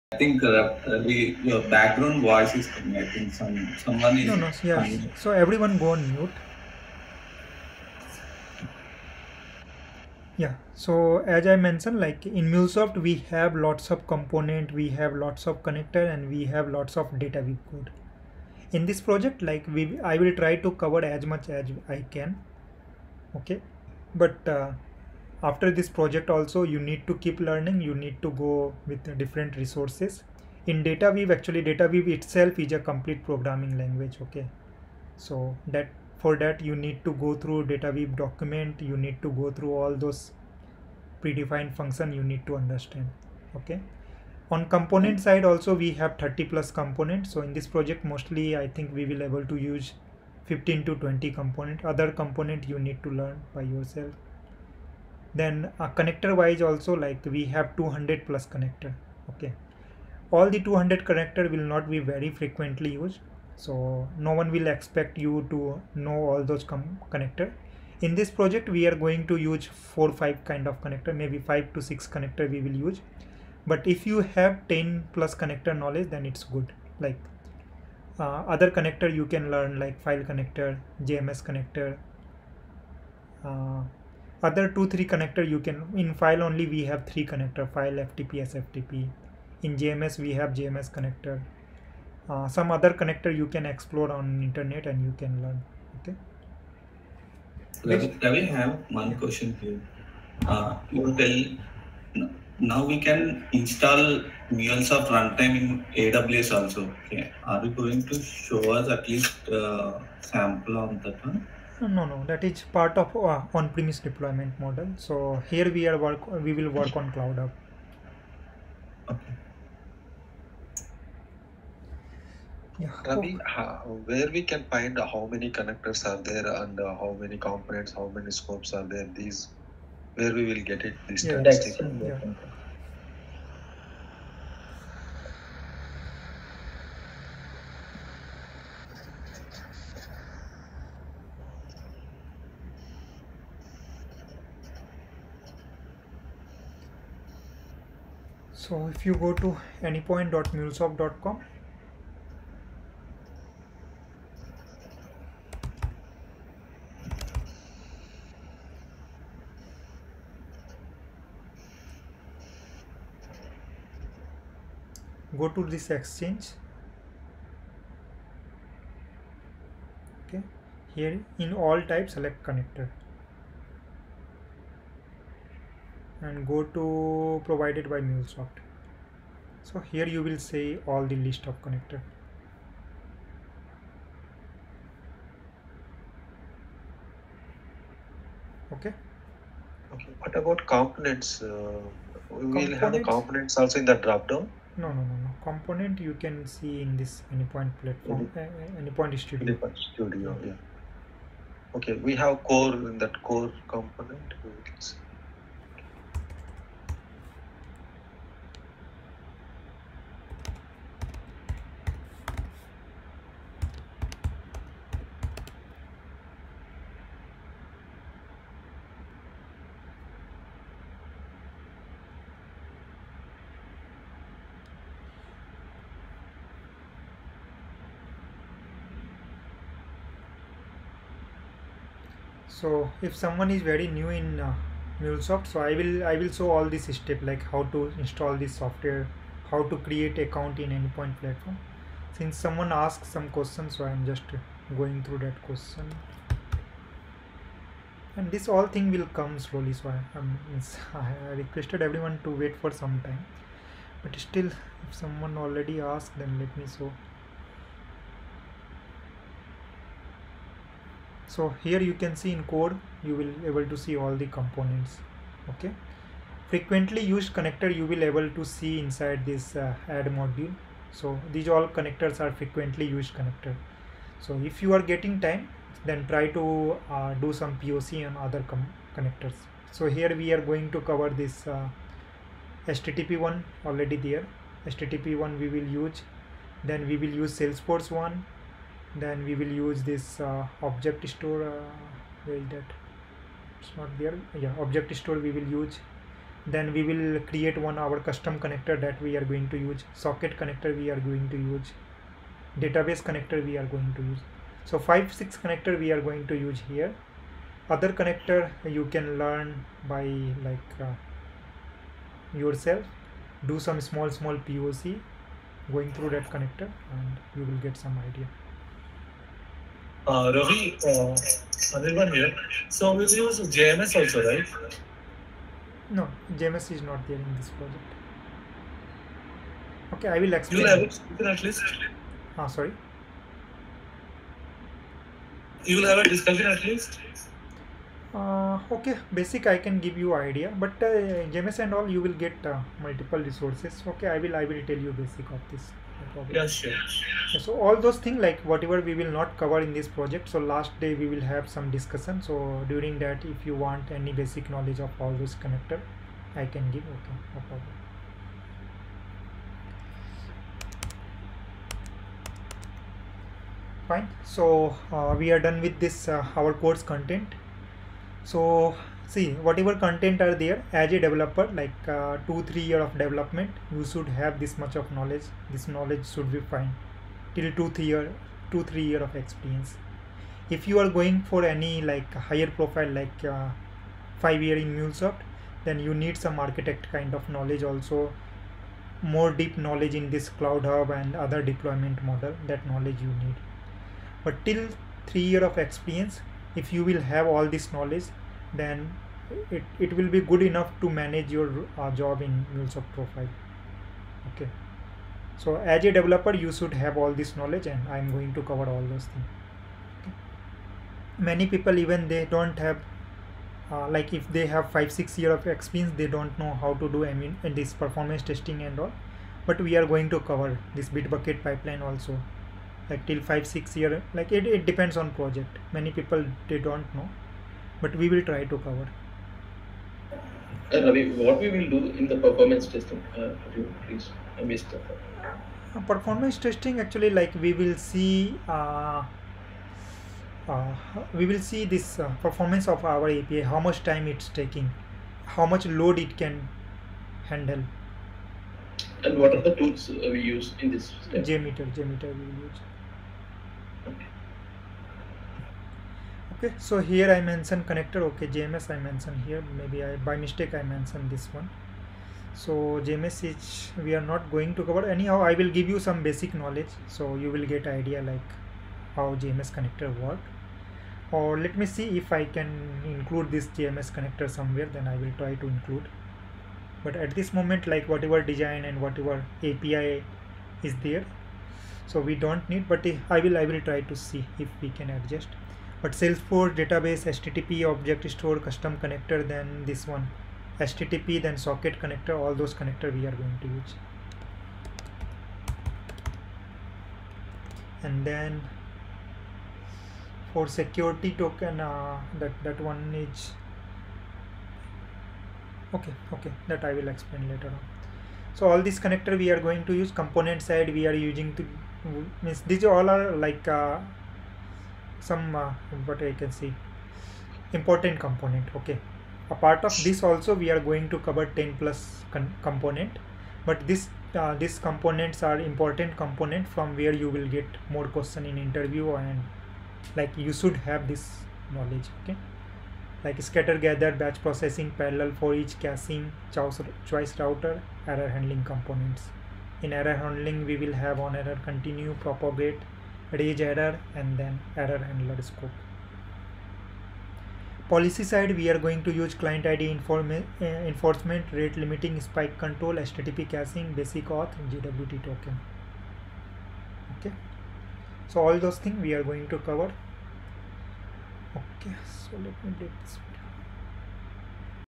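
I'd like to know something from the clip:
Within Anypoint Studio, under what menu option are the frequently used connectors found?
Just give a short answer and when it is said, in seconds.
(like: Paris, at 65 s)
add module, at 269 s.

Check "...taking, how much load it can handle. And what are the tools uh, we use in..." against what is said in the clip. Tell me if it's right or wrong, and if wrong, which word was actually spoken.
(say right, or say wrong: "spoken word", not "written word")
right.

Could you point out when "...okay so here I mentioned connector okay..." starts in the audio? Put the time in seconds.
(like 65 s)
456 s.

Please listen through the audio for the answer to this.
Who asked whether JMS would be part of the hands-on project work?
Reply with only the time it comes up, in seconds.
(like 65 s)
321 s.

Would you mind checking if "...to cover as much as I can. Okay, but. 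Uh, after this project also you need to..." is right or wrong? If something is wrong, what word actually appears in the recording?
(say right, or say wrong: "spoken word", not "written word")
right.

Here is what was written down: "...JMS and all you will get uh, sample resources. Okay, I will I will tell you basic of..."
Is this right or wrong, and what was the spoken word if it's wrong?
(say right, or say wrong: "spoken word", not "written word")
wrong: "multiple", not "sample".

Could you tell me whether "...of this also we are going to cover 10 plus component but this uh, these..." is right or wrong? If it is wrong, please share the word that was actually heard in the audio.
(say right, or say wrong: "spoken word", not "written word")
right.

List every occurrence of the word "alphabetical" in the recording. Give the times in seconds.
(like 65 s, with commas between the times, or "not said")
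not said.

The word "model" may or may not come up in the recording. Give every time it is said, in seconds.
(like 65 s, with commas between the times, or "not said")
114 s, 392 s.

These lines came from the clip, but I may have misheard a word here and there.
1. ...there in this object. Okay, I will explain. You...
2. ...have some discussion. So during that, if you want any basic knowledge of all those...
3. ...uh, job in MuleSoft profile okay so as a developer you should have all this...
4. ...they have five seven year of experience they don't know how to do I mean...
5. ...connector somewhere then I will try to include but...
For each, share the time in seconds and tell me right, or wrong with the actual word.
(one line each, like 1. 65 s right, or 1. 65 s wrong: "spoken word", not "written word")
1. 327 s wrong: "project", not "object"
2. 351 s right
3. 401 s right
4. 414 s wrong: "six", not "seven"
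5. 473 s right.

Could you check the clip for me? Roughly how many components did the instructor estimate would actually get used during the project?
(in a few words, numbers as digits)
15 to 20.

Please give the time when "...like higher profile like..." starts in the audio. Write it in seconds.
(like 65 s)
381 s.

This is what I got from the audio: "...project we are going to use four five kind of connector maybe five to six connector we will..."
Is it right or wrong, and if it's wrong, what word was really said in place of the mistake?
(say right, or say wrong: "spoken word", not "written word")
right.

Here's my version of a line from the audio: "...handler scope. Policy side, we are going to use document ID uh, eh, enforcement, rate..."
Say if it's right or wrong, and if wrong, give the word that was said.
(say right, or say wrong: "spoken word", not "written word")
wrong: "client", not "document".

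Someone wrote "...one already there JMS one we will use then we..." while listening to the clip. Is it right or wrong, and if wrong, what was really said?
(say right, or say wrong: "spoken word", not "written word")
wrong: "HTTP", not "JMS".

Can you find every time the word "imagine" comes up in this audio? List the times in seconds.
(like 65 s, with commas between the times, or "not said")
not said.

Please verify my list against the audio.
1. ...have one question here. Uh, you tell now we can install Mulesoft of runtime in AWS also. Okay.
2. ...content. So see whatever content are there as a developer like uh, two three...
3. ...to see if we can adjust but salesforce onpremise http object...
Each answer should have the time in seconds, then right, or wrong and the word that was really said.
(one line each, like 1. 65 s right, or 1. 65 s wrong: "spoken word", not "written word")
1. 98 s right
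2. 366 s right
3. 483 s wrong: "database", not "onpremise".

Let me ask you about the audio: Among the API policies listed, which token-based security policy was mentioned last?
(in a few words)
JWT token.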